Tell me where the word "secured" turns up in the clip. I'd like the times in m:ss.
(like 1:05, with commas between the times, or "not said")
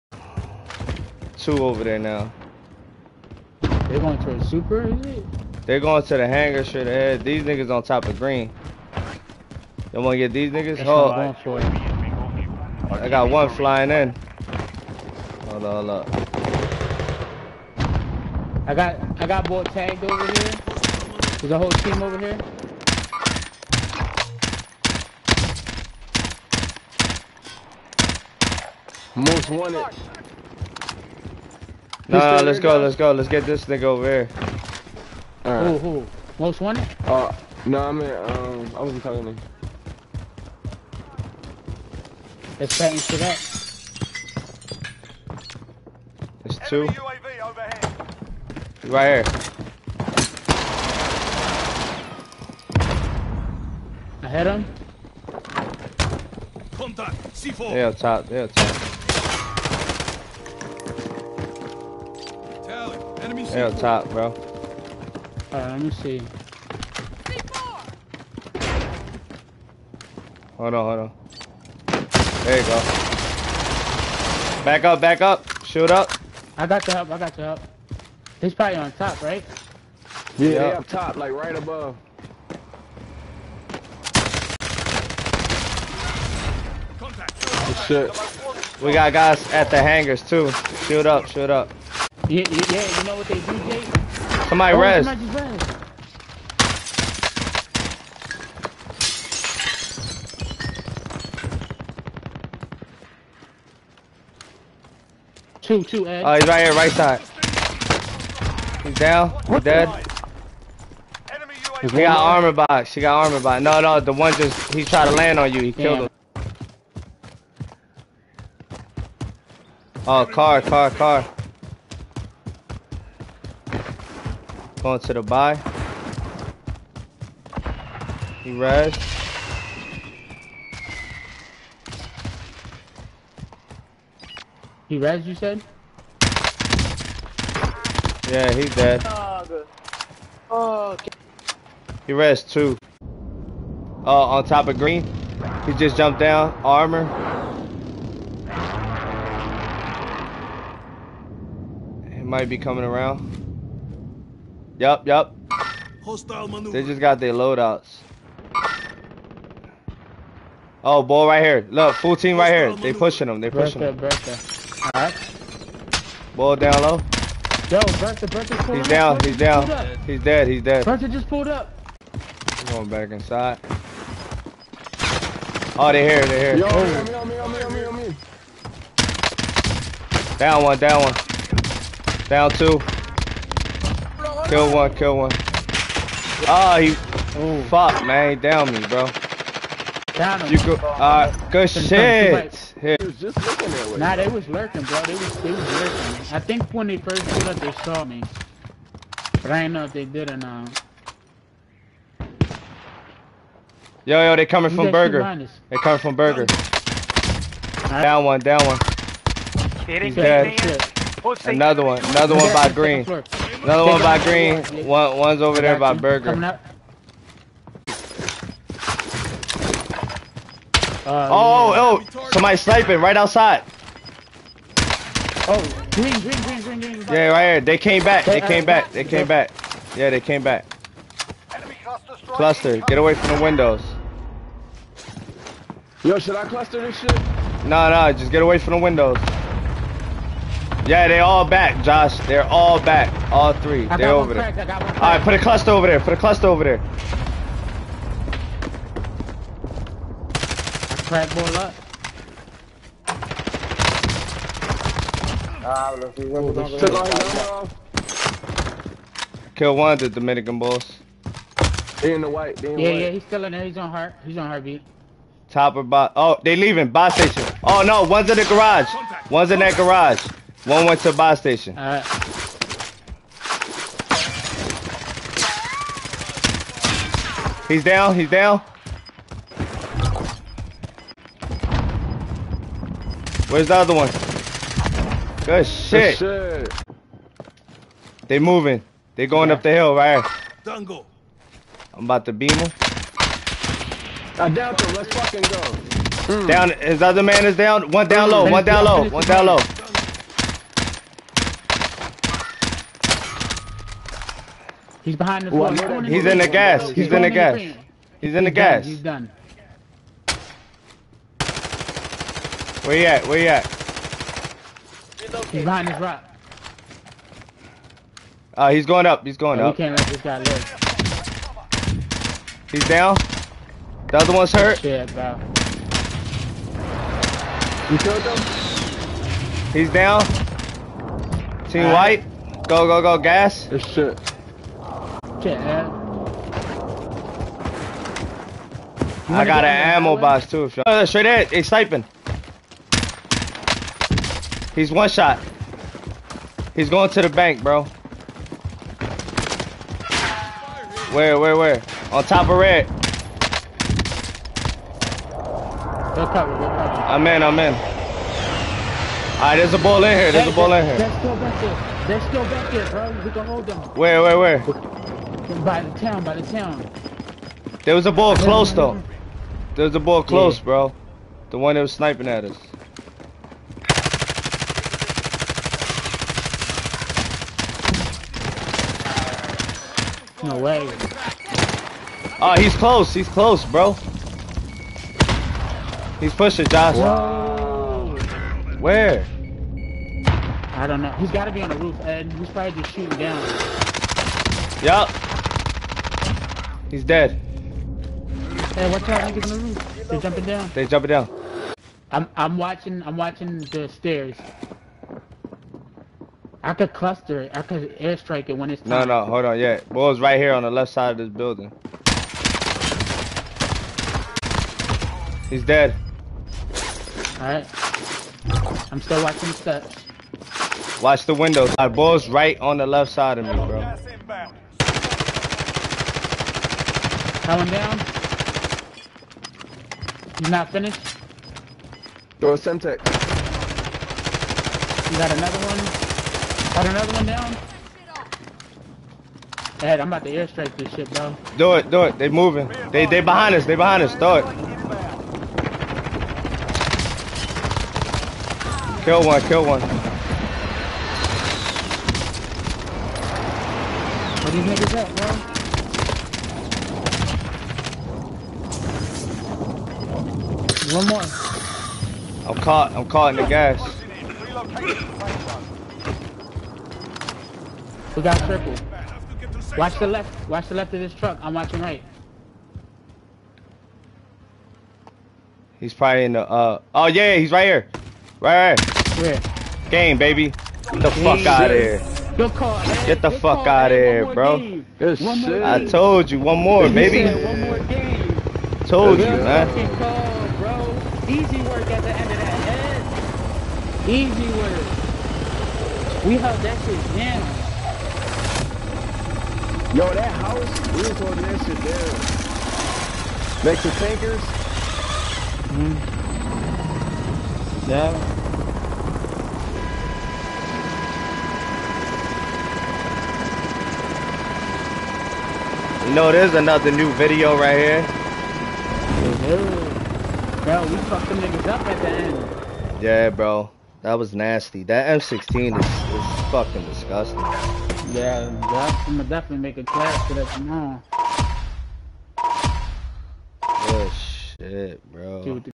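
not said.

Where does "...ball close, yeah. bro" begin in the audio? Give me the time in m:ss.
6:09.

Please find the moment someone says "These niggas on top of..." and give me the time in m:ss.
0:07.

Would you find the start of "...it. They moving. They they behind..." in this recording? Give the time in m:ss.
7:22.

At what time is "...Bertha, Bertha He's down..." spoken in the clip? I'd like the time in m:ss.
2:47.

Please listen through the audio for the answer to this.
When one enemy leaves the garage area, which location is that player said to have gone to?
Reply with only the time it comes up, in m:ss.
4:31.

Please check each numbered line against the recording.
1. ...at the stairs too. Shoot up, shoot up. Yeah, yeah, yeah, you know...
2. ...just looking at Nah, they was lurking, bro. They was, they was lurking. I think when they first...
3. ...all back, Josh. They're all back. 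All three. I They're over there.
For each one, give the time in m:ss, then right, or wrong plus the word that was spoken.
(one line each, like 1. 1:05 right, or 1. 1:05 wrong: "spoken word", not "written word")
1. 1:29 wrong: "hangars", not "stairs"
2. 3:13 right
3. 4:01 right.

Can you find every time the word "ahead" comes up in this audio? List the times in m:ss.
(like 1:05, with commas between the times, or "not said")
0:06, 5:41.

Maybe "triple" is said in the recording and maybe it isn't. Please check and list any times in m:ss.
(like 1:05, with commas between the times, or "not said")
7:48.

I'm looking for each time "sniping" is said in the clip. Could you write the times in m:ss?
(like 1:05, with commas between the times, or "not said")
3:42, 5:41, 6:11.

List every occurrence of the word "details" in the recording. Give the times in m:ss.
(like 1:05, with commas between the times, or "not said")
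not said.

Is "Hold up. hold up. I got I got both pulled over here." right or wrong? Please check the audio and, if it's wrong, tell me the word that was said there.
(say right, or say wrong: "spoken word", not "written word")
wrong: "tagged", not "pulled".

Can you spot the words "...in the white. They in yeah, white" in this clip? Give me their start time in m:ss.
4:22.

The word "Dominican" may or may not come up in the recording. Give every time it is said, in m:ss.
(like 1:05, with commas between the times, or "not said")
4:20.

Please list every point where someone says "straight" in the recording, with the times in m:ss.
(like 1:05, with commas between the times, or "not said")
0:06, 5:41.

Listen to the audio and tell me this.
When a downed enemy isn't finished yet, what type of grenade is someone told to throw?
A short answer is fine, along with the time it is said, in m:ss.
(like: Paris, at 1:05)
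Semtex, at 7:12.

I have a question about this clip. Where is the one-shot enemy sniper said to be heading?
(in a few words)
the bank.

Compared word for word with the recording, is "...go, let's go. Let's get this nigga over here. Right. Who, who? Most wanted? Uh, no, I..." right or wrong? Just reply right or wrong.
right.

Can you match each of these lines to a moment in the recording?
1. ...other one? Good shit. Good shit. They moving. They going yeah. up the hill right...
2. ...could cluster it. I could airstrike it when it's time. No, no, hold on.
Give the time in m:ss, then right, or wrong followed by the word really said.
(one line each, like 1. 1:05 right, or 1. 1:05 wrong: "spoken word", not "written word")
1. 4:43 right
2. 6:46 right.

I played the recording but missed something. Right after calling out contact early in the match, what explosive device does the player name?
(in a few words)
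C4.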